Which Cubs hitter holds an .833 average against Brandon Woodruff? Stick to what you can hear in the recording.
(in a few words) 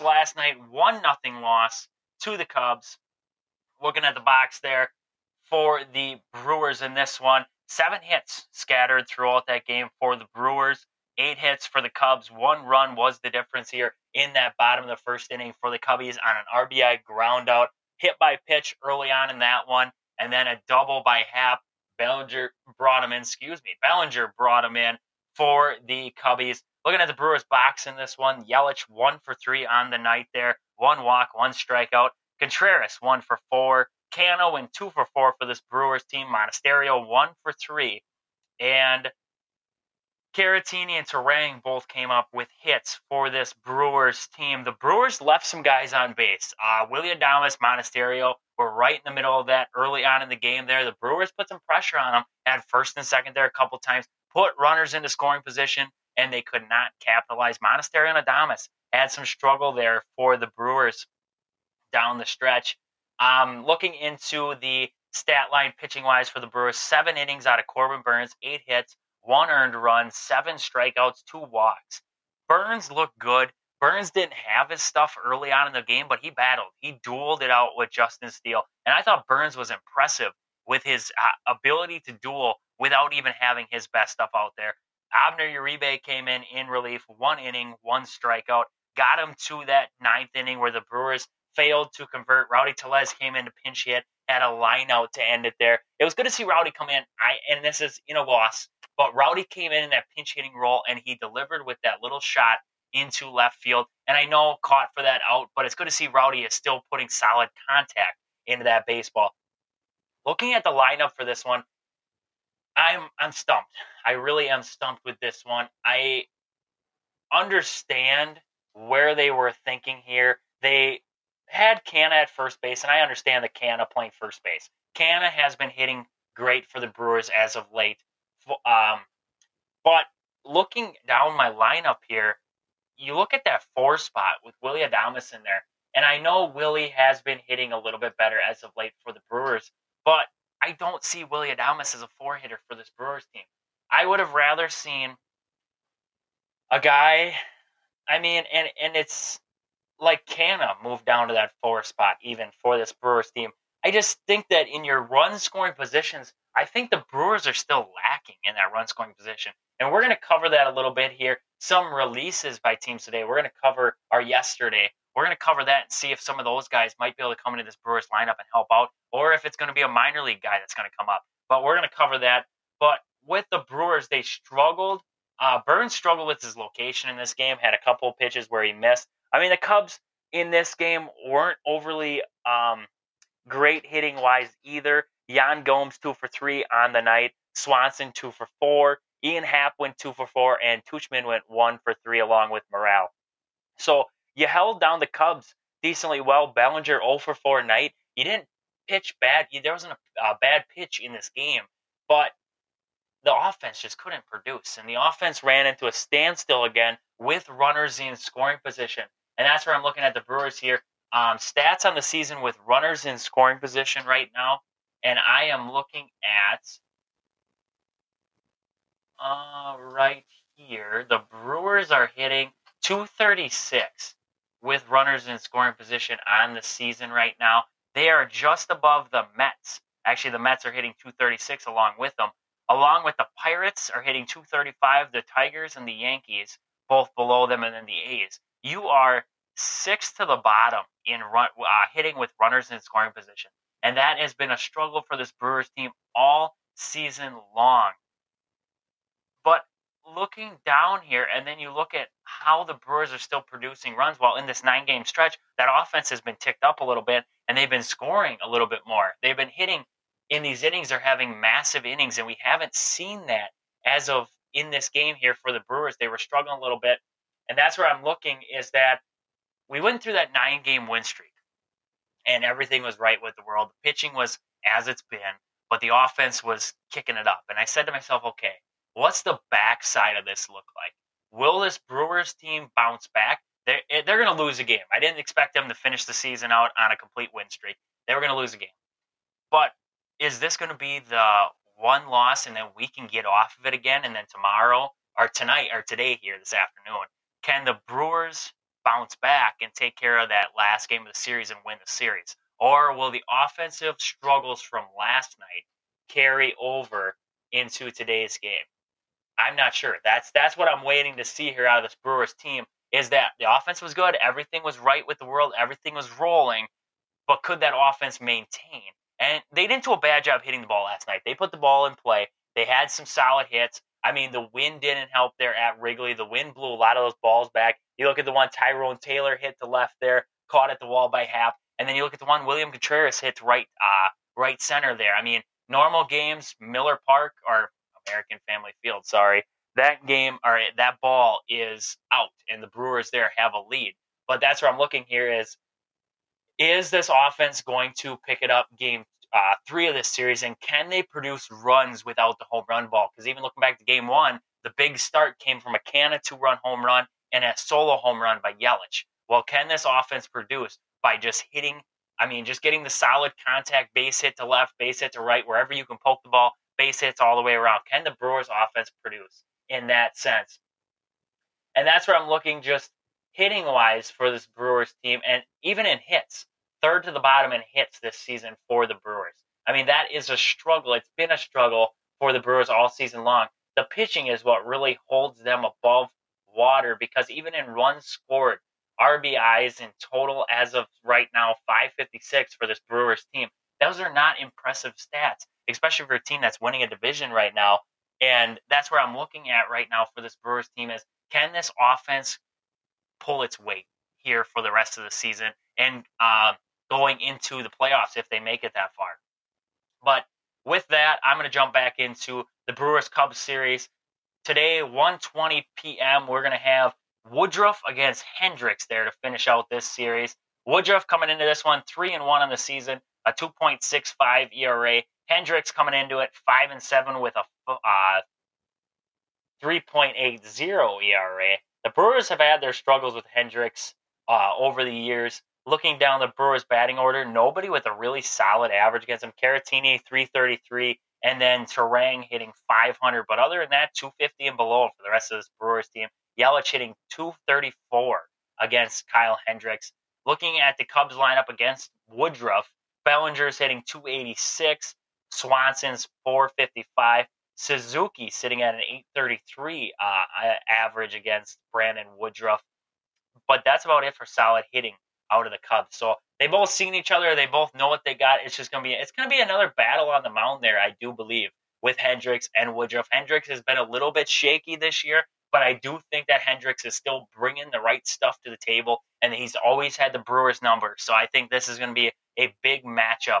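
Suzuki.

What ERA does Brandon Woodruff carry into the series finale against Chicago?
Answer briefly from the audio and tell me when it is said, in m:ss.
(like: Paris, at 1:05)
2.65, at 7:03.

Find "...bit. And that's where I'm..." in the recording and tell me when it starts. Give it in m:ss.
4:26.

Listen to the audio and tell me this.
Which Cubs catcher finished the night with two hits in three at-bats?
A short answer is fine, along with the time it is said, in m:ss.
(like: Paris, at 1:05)
Yan Gomes, at 3:05.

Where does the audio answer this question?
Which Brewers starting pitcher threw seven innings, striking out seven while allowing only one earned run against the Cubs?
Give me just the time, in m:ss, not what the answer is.
1:07.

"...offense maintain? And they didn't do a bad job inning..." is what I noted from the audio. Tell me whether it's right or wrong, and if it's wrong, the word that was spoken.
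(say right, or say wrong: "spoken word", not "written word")
wrong: "hitting", not "inning".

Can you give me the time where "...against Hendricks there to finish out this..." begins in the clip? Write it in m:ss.
6:57.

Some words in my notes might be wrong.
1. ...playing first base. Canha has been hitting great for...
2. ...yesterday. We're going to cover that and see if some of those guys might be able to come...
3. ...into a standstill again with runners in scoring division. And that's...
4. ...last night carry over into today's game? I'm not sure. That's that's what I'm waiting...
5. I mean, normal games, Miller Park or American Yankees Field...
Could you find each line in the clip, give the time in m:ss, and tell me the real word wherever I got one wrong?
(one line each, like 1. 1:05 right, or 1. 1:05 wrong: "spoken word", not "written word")
1. 2:03 right
2. 2:44 right
3. 3:25 wrong: "position", not "division"
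4. 5:04 right
5. 5:35 wrong: "Family", not "Yankees".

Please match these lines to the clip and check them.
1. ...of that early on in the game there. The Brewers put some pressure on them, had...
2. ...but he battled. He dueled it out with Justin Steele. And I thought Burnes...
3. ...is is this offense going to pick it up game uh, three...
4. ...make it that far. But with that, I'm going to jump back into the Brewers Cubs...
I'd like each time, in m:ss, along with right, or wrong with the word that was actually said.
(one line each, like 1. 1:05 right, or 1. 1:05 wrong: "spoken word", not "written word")
1. 0:49 right
2. 1:16 right
3. 5:45 right
4. 6:48 right.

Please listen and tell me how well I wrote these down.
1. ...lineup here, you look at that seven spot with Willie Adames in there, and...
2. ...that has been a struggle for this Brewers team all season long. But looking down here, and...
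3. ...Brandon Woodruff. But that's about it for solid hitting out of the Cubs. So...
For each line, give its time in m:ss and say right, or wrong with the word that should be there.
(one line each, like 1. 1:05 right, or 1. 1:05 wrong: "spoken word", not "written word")
1. 2:11 wrong: "four", not "seven"
2. 4:03 right
3. 7:41 right.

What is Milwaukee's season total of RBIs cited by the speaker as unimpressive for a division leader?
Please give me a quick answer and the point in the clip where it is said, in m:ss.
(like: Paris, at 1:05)
556, at 6:31.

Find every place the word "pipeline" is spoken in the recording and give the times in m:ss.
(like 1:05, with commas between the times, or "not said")
not said.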